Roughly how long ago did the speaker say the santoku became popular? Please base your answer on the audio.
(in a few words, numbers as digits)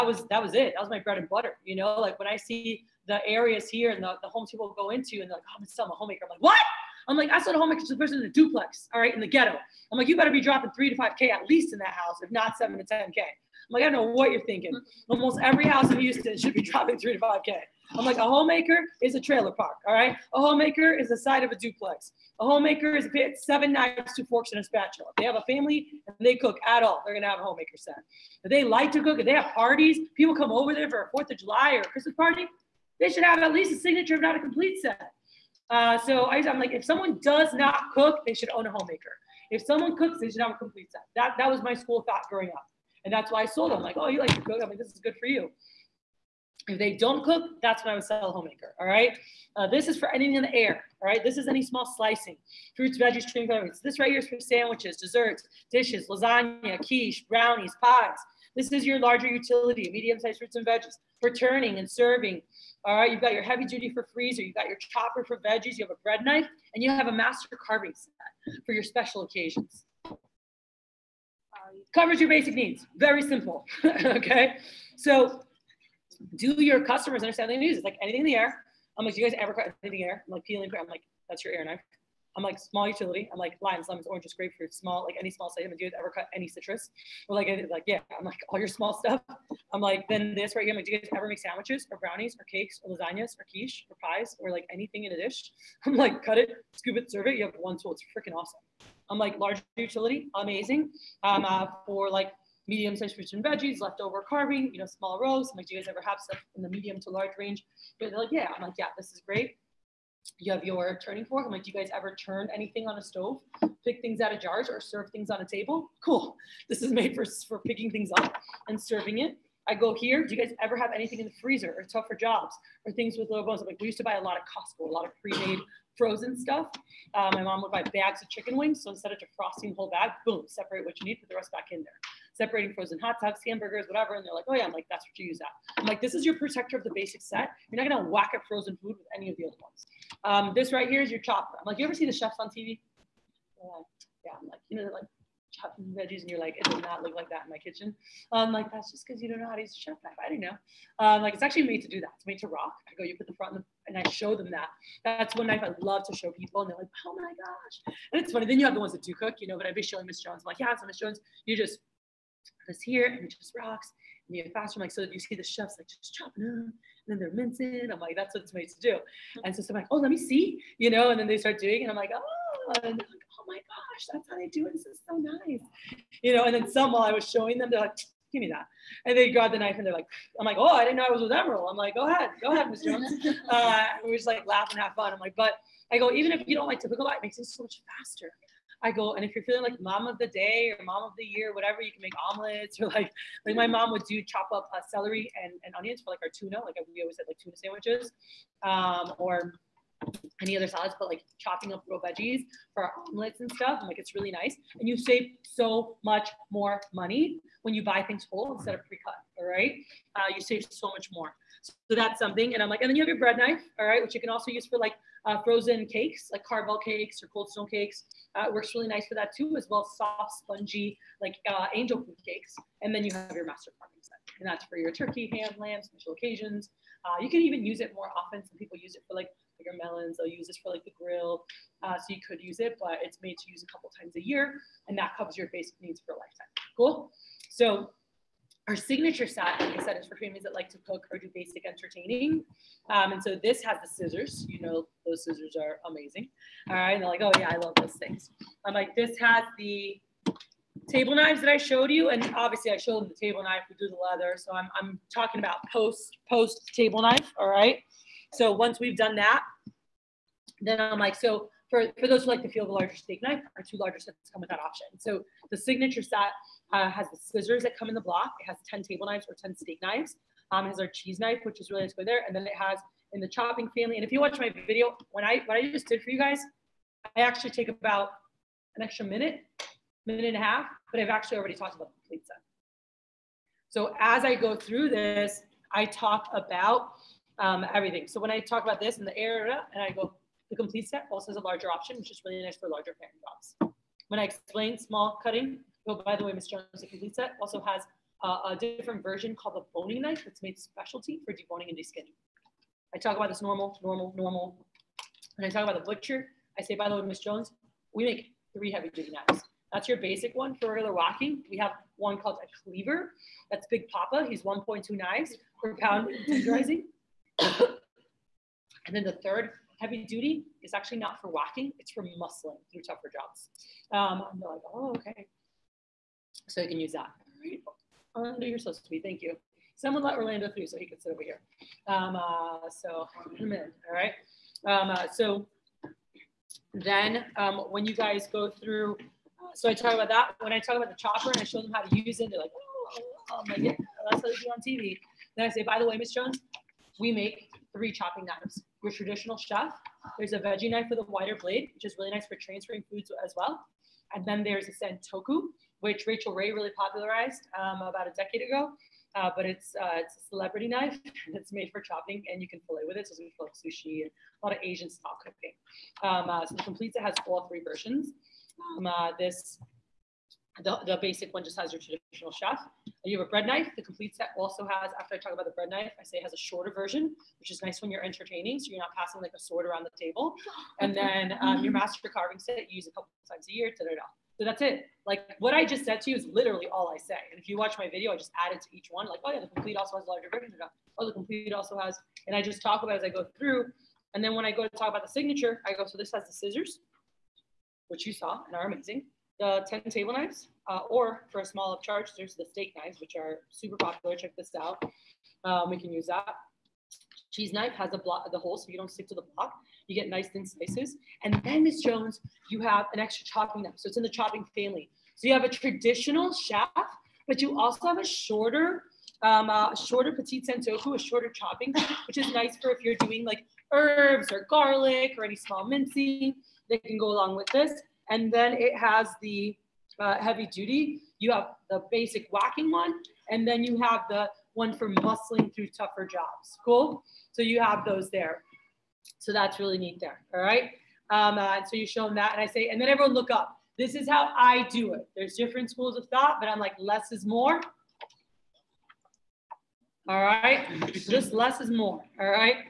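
a decade ago.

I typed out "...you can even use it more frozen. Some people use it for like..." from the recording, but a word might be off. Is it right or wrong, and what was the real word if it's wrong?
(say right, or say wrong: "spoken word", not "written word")
wrong: "often", not "frozen".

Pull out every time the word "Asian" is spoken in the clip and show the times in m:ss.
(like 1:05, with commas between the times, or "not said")
6:04.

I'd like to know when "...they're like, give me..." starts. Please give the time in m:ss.
2:57.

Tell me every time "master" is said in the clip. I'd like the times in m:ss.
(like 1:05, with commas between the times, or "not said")
1:07, 3:43, 6:21.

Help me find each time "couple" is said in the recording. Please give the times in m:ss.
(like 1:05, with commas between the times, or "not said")
3:53, 6:22.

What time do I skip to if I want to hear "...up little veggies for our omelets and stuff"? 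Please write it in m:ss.
3:21.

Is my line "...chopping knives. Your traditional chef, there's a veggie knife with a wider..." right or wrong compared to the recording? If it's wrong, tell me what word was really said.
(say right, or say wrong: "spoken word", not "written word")
right.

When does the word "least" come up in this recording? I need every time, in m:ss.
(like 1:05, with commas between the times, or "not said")
0:11, 0:33.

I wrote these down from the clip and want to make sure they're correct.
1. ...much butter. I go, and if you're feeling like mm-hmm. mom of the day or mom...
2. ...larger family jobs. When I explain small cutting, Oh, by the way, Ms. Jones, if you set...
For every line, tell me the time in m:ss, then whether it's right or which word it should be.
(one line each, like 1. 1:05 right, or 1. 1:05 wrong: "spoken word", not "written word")
1. 3:07 wrong: "faster", not "butter"
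2. 4:52 right.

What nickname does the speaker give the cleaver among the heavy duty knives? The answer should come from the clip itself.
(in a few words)
Big Papa.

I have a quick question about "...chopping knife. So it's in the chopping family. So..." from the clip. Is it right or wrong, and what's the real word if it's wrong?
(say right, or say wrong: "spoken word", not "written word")
right.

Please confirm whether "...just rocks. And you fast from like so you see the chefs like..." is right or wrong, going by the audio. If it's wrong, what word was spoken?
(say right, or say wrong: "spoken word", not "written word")
right.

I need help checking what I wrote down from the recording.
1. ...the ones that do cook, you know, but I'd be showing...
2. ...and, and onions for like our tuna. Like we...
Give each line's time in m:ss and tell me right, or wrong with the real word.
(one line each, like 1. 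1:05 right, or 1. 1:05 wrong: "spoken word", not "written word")
1. 2:38 right
2. 3:15 right.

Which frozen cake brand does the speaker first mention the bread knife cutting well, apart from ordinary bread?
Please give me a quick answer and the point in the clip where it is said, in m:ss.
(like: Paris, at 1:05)
Carvel, at 3:36.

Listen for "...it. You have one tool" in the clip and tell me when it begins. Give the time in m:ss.
1:37.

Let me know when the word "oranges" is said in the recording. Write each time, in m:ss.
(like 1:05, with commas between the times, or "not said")
1:24.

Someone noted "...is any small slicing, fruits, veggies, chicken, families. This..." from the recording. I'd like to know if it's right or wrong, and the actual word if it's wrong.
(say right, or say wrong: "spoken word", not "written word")
wrong: "calories", not "families".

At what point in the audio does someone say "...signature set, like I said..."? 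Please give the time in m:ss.
3:58.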